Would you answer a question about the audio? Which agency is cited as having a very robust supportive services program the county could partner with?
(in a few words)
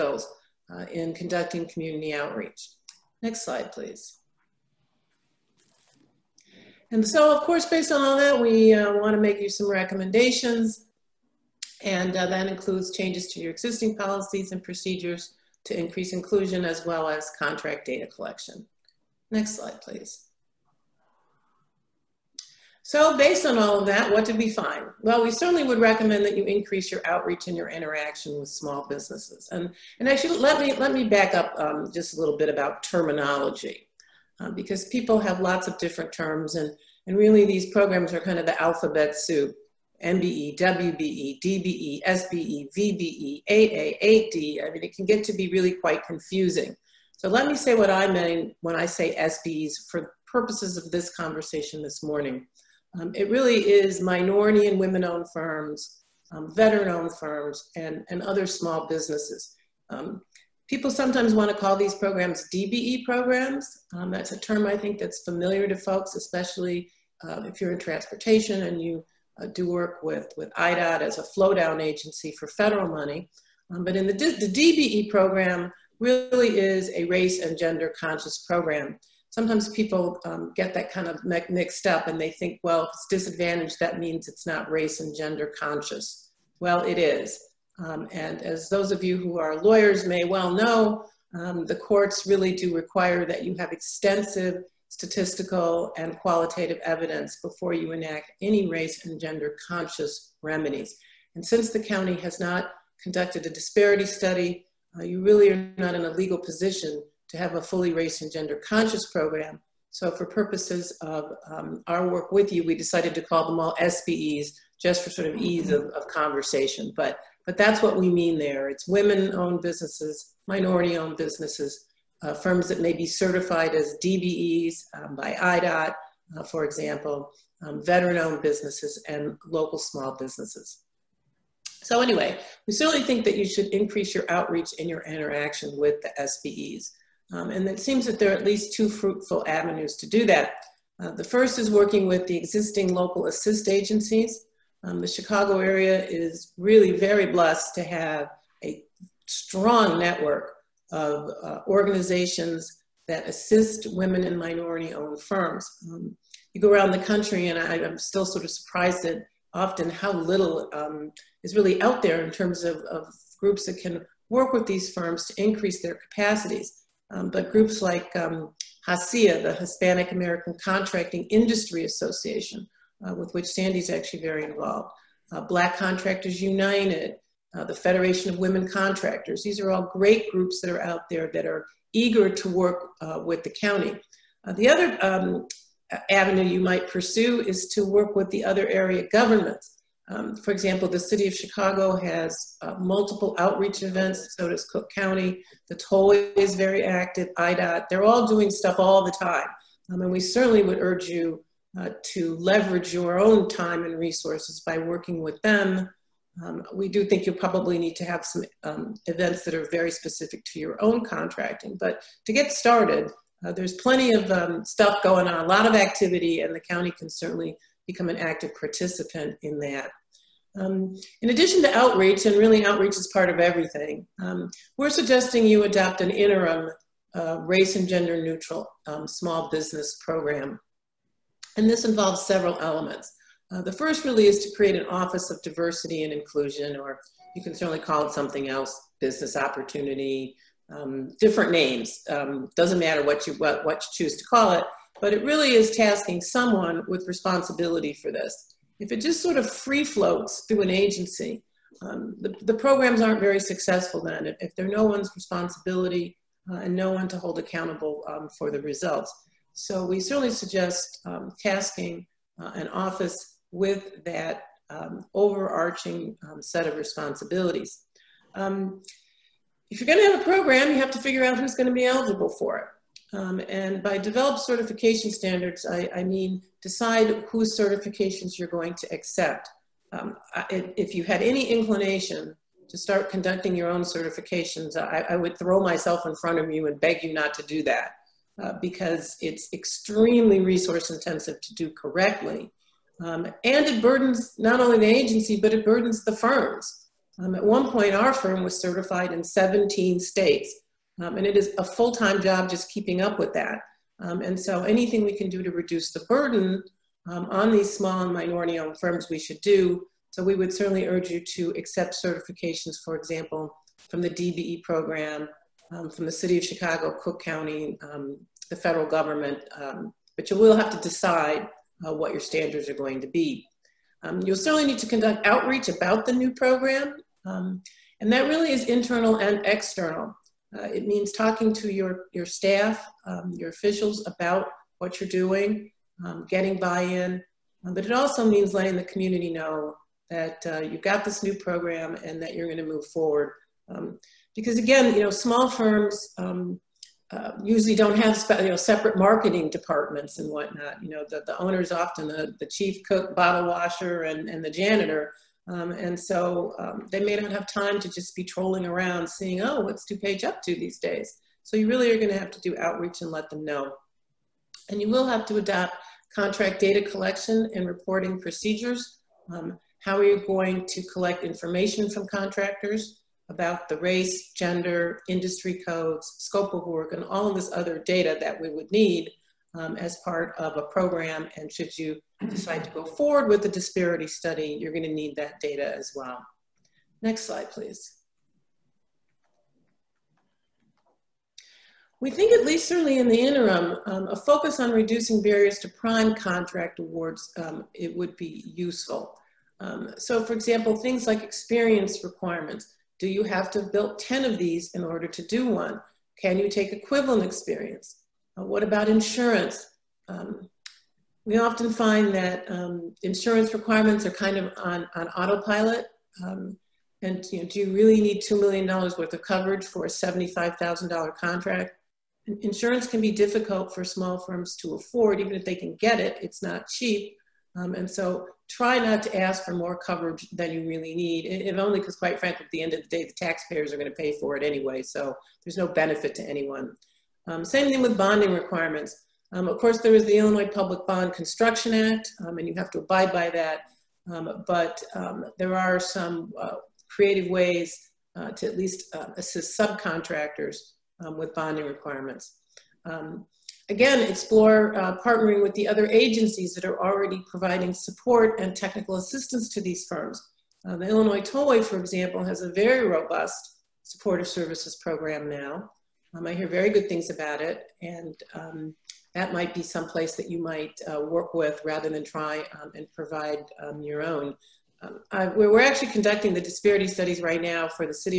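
Illinois Tollway.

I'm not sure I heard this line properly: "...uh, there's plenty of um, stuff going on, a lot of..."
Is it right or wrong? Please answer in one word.
right.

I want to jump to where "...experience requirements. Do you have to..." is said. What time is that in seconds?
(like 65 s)
401 s.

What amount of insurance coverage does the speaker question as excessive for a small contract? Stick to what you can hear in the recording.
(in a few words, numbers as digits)
$2 million.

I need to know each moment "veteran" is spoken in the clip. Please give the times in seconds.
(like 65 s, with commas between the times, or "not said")
56 s, 127 s.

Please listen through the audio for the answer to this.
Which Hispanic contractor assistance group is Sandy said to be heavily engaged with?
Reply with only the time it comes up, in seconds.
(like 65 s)
168 s.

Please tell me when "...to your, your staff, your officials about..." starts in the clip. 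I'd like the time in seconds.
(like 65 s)
331 s.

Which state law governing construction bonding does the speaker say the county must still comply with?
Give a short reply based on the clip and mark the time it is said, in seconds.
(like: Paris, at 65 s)
Illinois Public Bond Construction Act, at 440 s.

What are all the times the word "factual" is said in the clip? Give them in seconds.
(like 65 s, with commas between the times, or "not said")
not said.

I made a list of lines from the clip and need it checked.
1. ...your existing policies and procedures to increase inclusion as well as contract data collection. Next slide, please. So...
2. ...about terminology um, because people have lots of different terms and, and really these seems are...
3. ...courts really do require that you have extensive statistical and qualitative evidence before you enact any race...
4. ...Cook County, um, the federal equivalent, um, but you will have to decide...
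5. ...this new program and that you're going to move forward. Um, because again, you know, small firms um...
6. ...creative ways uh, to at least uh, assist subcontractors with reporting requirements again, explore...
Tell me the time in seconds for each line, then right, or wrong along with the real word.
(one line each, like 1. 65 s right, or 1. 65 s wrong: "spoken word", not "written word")
1. 13 s right
2. 32 s wrong: "programs", not "seems"
3. 91 s right
4. 317 s wrong: "government", not "equivalent"
5. 341 s right
6. 446 s wrong: "bonding", not "reporting".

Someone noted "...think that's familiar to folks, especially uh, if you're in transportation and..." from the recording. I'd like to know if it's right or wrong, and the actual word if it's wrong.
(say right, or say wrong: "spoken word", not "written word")
right.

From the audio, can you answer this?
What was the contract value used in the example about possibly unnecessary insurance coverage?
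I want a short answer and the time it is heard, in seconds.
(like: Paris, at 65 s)
$75,000, at 419 s.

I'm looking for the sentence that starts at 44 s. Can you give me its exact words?
I mean, it can get to be really quite confusing.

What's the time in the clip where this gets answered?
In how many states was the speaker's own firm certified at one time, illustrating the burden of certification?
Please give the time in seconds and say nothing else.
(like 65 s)
299 s.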